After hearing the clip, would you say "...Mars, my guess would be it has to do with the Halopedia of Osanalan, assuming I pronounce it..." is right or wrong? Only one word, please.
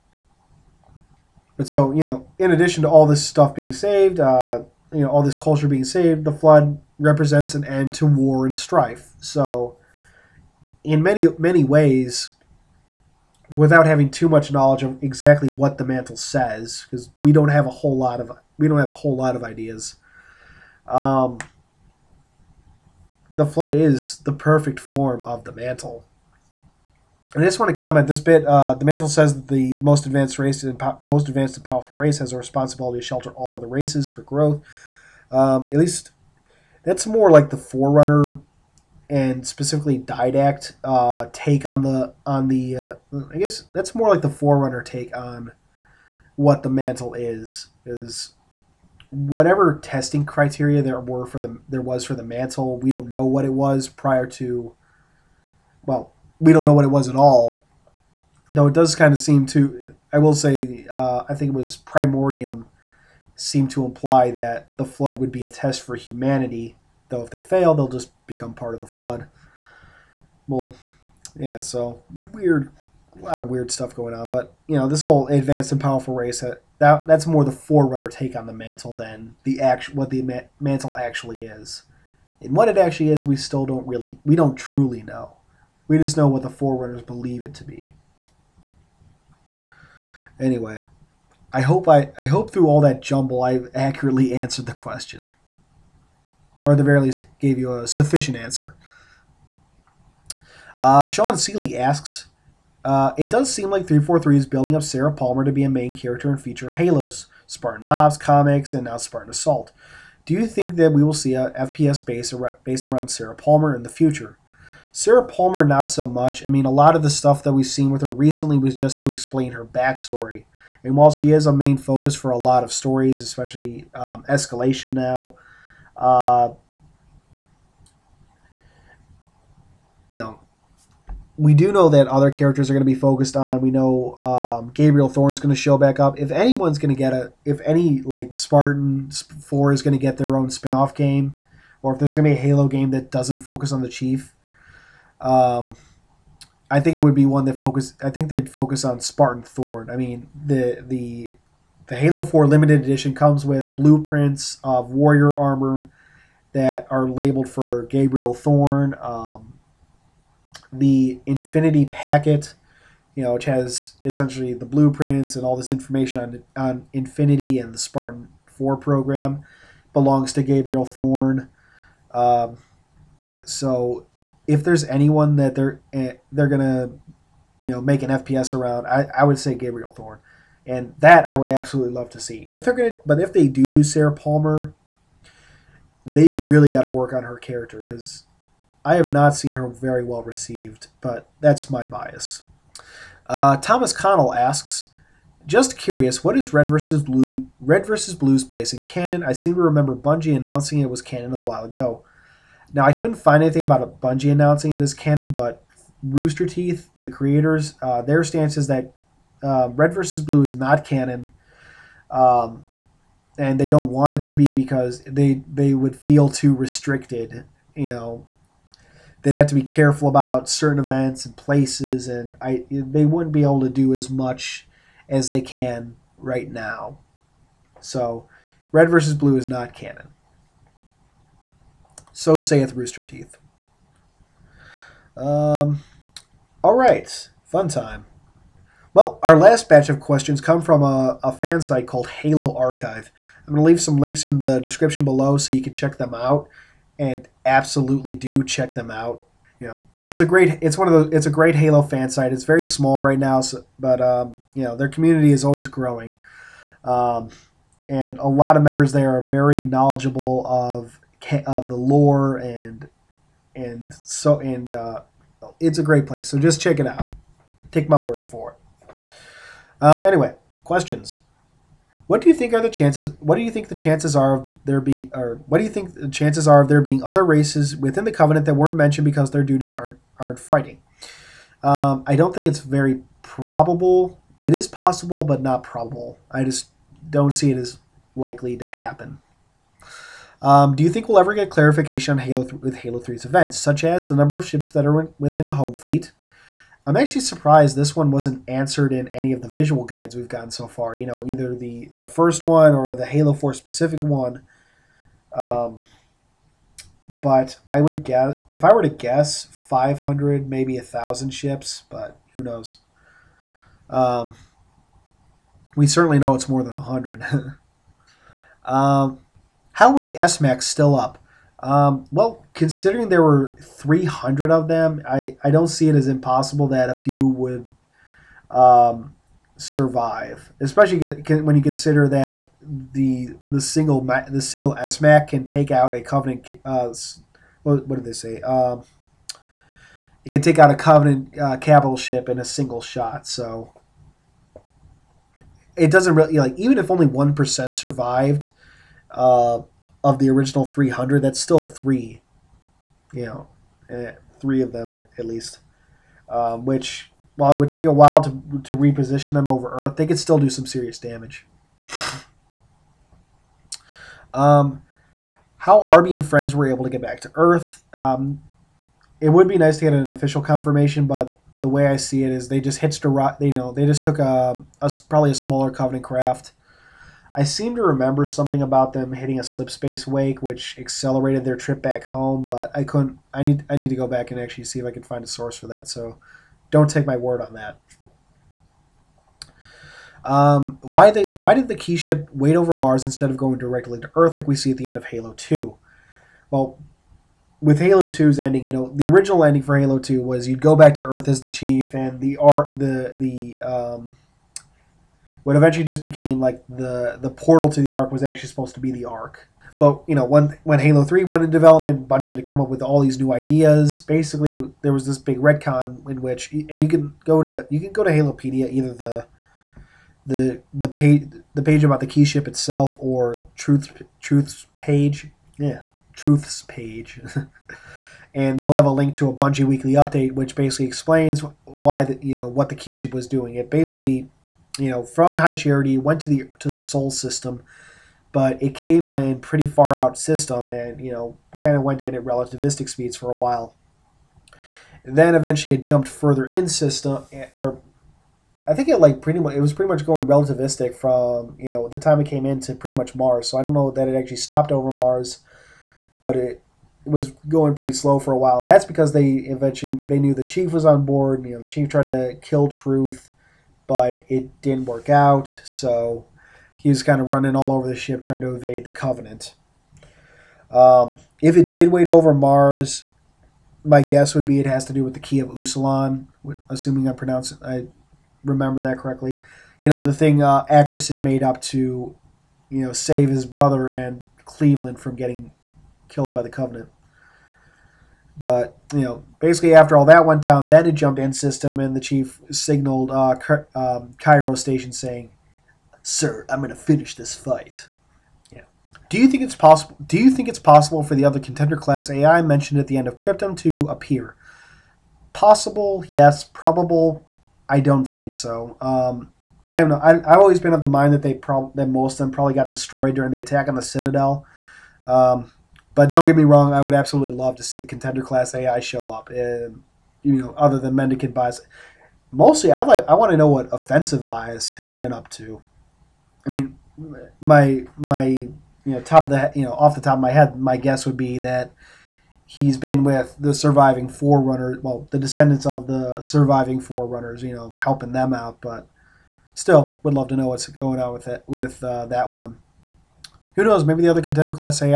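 wrong.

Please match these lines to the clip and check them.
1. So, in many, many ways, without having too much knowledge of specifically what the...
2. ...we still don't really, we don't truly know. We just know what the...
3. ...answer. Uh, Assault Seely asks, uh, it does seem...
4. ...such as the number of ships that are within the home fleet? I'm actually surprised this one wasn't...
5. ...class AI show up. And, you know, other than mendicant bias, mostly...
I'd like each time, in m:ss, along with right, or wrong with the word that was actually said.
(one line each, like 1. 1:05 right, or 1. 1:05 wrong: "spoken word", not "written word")
1. 0:09 wrong: "exactly", not "specifically"
2. 1:23 right
3. 1:38 wrong: "Sean", not "Assault"
4. 4:53 right
5. 8:38 right.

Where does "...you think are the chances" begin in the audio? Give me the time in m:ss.
4:32.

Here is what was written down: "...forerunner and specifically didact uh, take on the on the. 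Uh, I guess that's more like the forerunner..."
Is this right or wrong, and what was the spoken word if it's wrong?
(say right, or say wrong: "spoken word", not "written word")
right.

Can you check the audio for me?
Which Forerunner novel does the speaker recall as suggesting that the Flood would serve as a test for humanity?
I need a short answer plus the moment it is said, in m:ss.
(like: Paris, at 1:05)
Primordium, at 1:01.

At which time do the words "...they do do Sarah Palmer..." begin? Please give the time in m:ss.
3:03.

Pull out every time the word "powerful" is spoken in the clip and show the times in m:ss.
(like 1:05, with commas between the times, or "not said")
0:31, 1:15.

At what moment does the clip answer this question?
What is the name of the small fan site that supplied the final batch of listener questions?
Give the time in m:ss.
4:02.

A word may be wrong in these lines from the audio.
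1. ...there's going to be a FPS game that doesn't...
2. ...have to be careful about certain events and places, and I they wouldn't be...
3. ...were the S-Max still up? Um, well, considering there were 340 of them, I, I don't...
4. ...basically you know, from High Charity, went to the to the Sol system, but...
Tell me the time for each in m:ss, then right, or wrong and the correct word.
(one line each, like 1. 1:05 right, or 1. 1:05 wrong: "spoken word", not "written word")
1. 2:21 wrong: "Halo", not "FPS"
2. 3:39 right
3. 5:19 wrong: "300", not "340"
4. 7:13 right.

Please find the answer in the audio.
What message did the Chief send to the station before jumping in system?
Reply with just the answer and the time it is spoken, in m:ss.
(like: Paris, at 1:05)
I'm going to finish this fight, at 8:16.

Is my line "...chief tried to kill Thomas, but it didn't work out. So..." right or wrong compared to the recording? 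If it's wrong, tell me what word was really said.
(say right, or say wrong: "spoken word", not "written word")
wrong: "Truth", not "Thomas".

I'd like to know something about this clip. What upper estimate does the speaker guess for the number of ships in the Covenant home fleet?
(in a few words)
1000.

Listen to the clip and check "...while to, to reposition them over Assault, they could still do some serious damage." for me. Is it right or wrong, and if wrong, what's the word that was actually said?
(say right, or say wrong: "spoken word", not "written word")
wrong: "Earth", not "Assault".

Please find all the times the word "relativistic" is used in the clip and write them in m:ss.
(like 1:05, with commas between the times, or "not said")
7:22, 7:30.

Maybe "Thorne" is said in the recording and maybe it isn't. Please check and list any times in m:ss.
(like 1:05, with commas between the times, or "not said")
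2:15, 2:29, 2:38, 2:50, 2:59.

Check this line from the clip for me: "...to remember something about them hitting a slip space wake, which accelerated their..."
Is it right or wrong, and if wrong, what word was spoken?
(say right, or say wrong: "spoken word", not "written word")
right.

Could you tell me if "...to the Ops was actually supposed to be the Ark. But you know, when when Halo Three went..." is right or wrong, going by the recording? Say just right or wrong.
wrong.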